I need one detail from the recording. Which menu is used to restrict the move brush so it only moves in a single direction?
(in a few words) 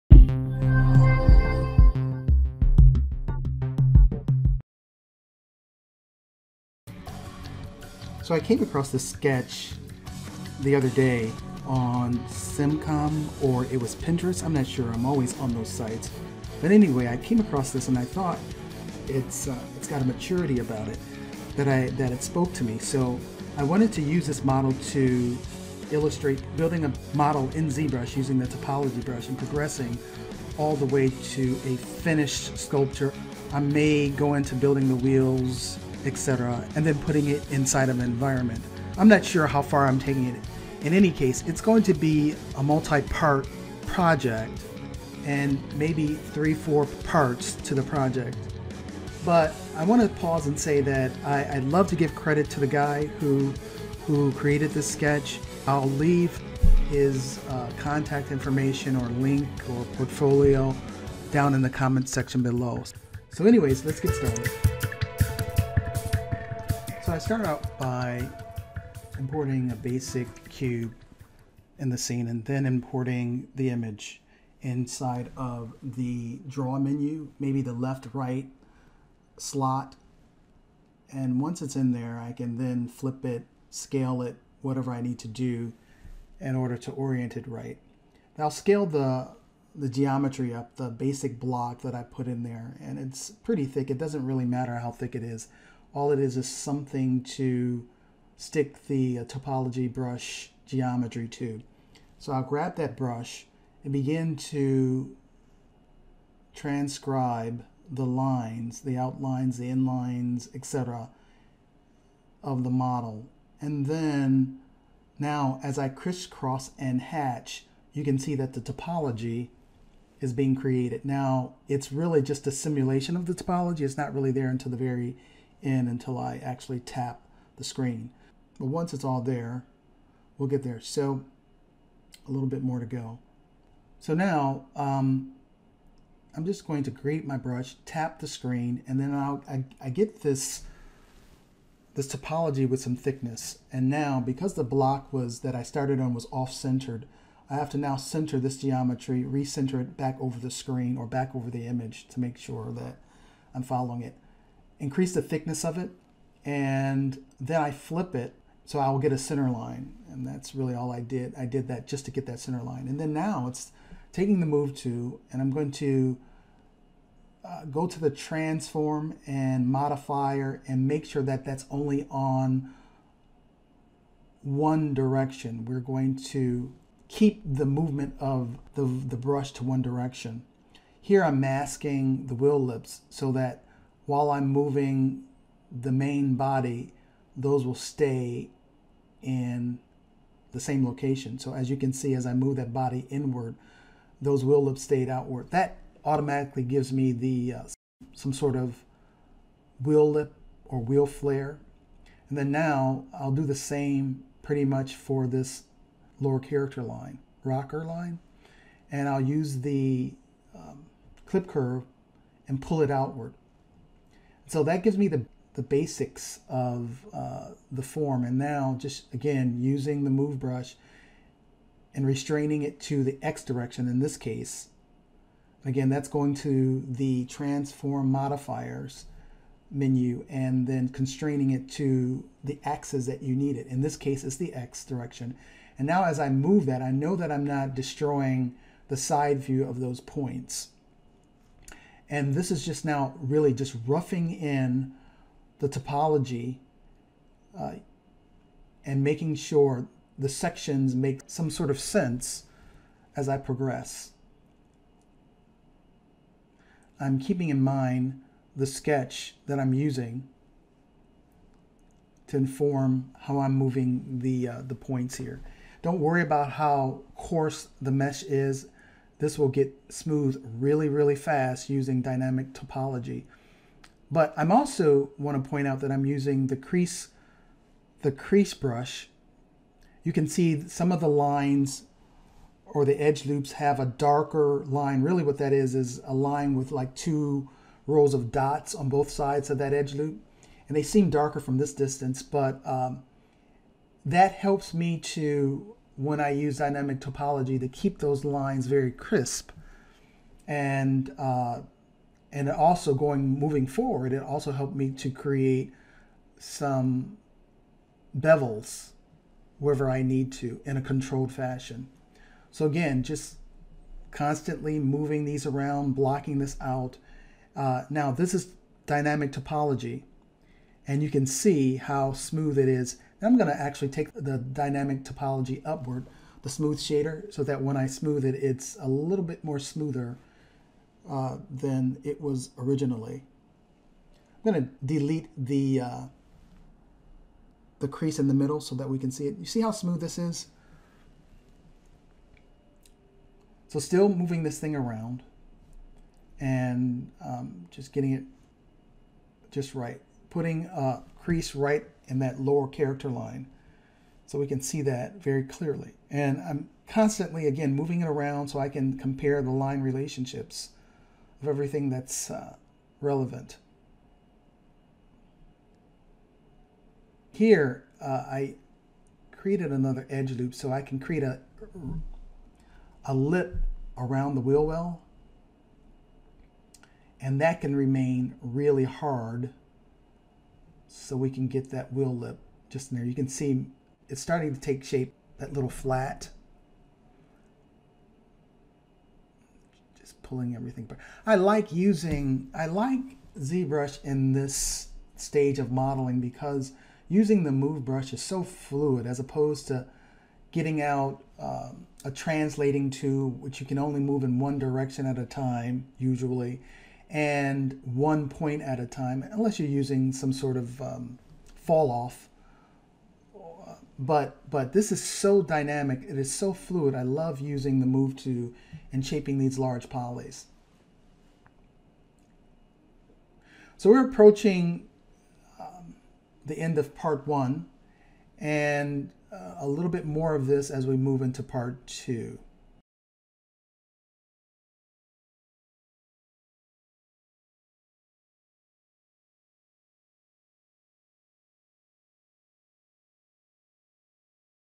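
transform modifiers.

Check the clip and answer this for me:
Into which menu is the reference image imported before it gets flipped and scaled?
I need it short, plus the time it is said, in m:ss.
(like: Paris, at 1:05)
draw menu, at 1:16.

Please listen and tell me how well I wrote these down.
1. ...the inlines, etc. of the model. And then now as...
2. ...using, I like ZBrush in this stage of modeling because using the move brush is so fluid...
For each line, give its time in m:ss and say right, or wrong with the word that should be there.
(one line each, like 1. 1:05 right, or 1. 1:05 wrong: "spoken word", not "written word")
1. 1:49 right
2. 6:31 right.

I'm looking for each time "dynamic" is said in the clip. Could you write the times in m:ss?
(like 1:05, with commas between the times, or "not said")
4:32, 4:56, 5:18, 5:24, 6:55.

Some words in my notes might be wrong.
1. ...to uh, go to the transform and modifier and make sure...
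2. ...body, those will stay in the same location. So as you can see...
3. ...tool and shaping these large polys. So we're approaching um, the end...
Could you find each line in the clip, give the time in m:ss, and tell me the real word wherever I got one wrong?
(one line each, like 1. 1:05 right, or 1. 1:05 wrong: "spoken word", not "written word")
1. 2:45 right
2. 3:06 right
3. 6:58 right.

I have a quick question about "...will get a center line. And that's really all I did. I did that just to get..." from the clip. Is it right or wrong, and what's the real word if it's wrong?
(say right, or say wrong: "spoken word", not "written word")
right.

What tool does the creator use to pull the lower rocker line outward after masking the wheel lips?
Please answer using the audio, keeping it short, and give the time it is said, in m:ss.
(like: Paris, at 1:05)
clip curve, at 3:31.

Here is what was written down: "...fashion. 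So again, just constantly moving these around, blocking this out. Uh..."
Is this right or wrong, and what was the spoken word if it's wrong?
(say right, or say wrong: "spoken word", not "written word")
right.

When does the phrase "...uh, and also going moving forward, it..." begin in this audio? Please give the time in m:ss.
5:01.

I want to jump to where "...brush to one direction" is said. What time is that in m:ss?
2:59.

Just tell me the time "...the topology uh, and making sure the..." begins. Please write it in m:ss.
4:05.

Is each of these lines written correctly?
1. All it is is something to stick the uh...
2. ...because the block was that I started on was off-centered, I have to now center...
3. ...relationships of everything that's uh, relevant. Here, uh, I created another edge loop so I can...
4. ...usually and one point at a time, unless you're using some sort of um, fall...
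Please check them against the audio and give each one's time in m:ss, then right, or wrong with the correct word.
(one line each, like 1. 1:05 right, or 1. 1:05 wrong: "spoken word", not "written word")
1. 1:35 right
2. 2:24 right
3. 5:59 right
4. 6:45 right.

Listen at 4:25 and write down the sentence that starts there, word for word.
Don't worry about how coarse the mesh is.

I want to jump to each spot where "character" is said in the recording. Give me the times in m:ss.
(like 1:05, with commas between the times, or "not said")
3:26, 5:52.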